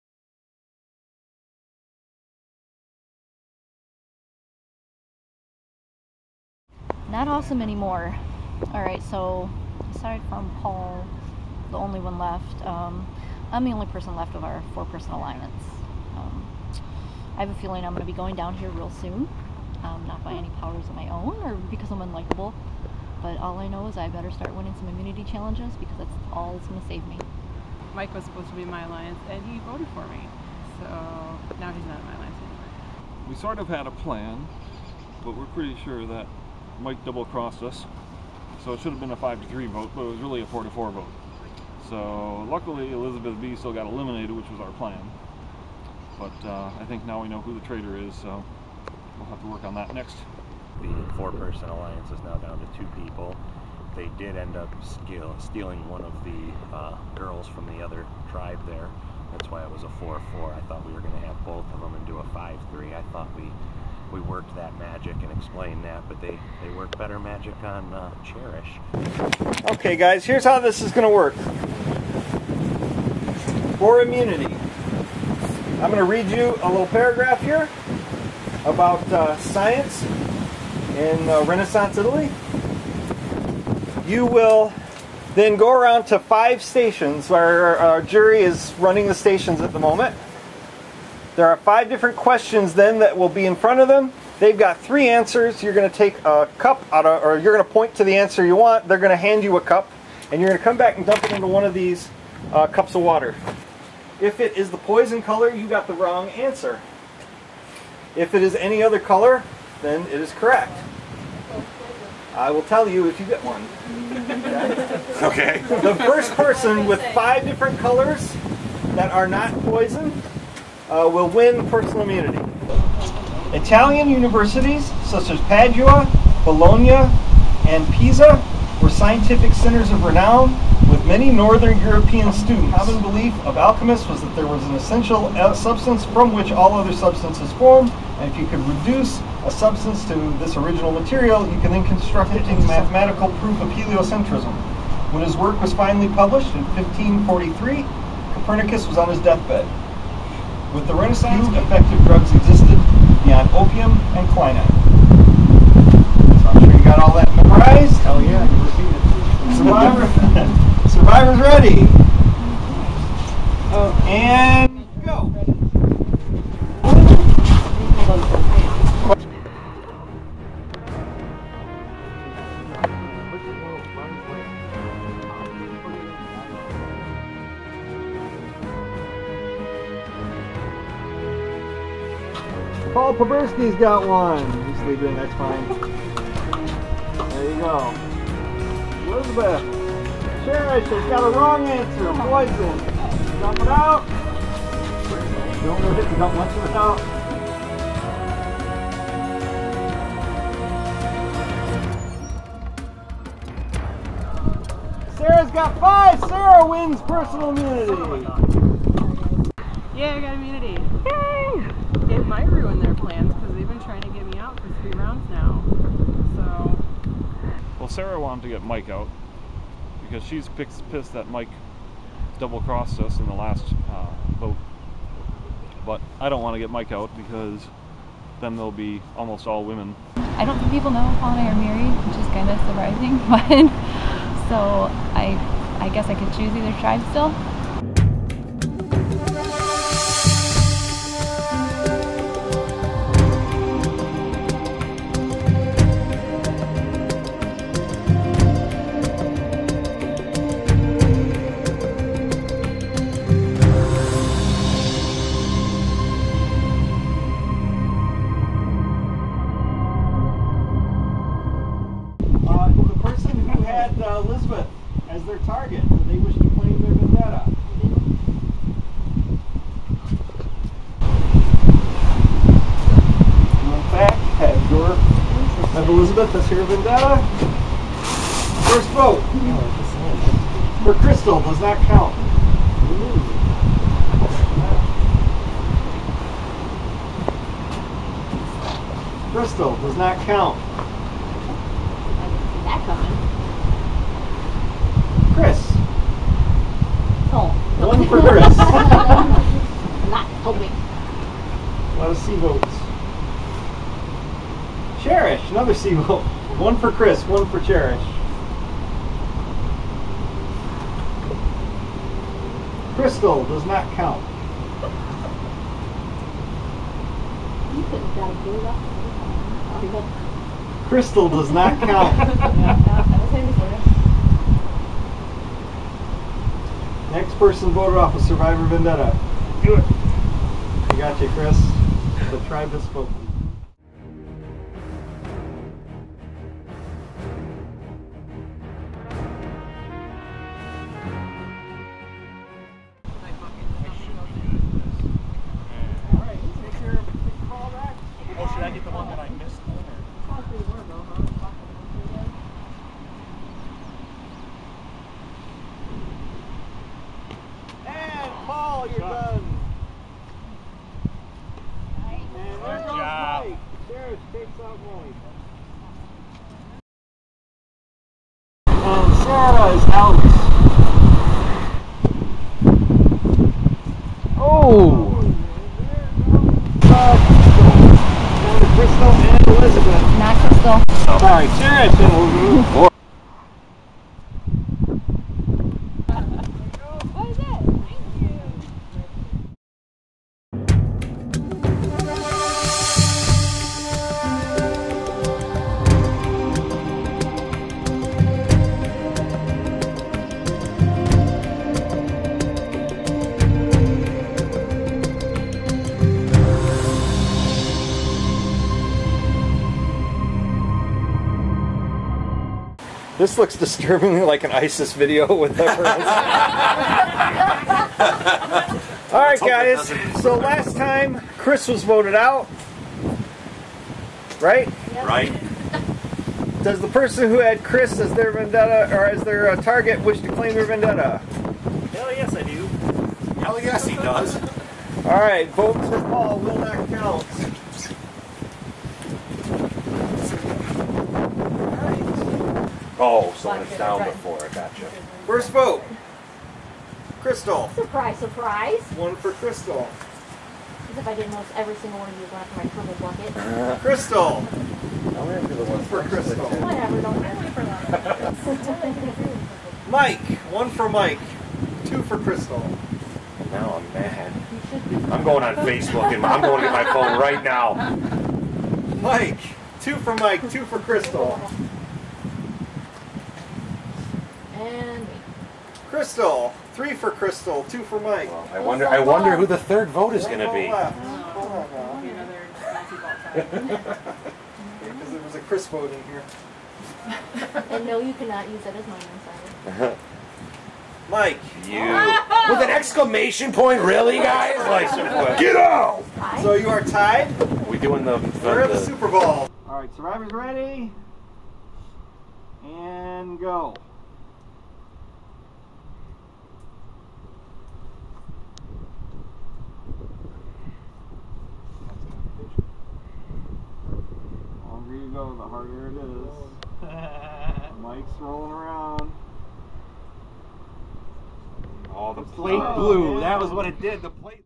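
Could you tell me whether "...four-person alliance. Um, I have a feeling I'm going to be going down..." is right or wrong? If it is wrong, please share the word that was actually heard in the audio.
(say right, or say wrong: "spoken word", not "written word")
right.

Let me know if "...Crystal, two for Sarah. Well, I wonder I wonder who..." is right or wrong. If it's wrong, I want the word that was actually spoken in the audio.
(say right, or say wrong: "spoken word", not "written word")
wrong: "Mike", not "Sarah".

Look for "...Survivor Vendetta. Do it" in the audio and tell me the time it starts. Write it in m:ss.
5:28.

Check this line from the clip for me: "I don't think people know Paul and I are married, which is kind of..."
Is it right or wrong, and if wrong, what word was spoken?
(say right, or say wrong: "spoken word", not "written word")
right.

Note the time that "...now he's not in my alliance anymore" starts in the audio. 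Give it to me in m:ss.
0:31.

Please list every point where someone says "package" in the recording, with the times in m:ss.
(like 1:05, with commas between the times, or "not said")
not said.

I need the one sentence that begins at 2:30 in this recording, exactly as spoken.
With the Renaissance, effective drugs existed beyond opium and quinine.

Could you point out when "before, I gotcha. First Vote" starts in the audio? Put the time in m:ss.
7:24.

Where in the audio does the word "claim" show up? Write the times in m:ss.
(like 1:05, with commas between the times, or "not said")
4:26, 7:10.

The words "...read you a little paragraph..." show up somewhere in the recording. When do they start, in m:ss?
1:16.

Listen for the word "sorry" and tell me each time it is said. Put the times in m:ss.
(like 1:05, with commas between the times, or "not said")
6:21, 8:09.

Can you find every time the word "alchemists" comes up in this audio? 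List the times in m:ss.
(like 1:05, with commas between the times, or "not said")
2:13.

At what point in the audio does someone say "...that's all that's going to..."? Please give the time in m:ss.
0:25.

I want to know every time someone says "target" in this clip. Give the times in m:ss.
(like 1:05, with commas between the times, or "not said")
4:25, 7:09.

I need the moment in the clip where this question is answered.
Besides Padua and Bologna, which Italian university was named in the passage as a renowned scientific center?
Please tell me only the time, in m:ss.
2:07.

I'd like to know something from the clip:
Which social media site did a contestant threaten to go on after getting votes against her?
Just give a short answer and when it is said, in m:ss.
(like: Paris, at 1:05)
Facebook, at 7:45.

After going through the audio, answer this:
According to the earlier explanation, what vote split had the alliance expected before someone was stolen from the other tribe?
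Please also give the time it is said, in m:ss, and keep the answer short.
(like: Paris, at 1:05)
5 to 3, at 0:39.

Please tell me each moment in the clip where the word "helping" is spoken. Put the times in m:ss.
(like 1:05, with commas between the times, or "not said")
5:00.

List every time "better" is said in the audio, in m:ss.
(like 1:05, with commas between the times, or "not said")
0:24, 1:06.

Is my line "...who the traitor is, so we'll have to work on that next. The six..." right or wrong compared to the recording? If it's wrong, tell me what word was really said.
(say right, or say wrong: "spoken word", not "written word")
wrong: "four", not "six".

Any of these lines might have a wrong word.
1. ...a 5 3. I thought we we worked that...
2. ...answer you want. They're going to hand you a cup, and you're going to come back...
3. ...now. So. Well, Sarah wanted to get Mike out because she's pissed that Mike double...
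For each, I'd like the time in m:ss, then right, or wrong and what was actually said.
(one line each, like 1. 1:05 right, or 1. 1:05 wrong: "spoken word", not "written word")
1. 1:02 right
2. 1:38 right
3. 3:35 right.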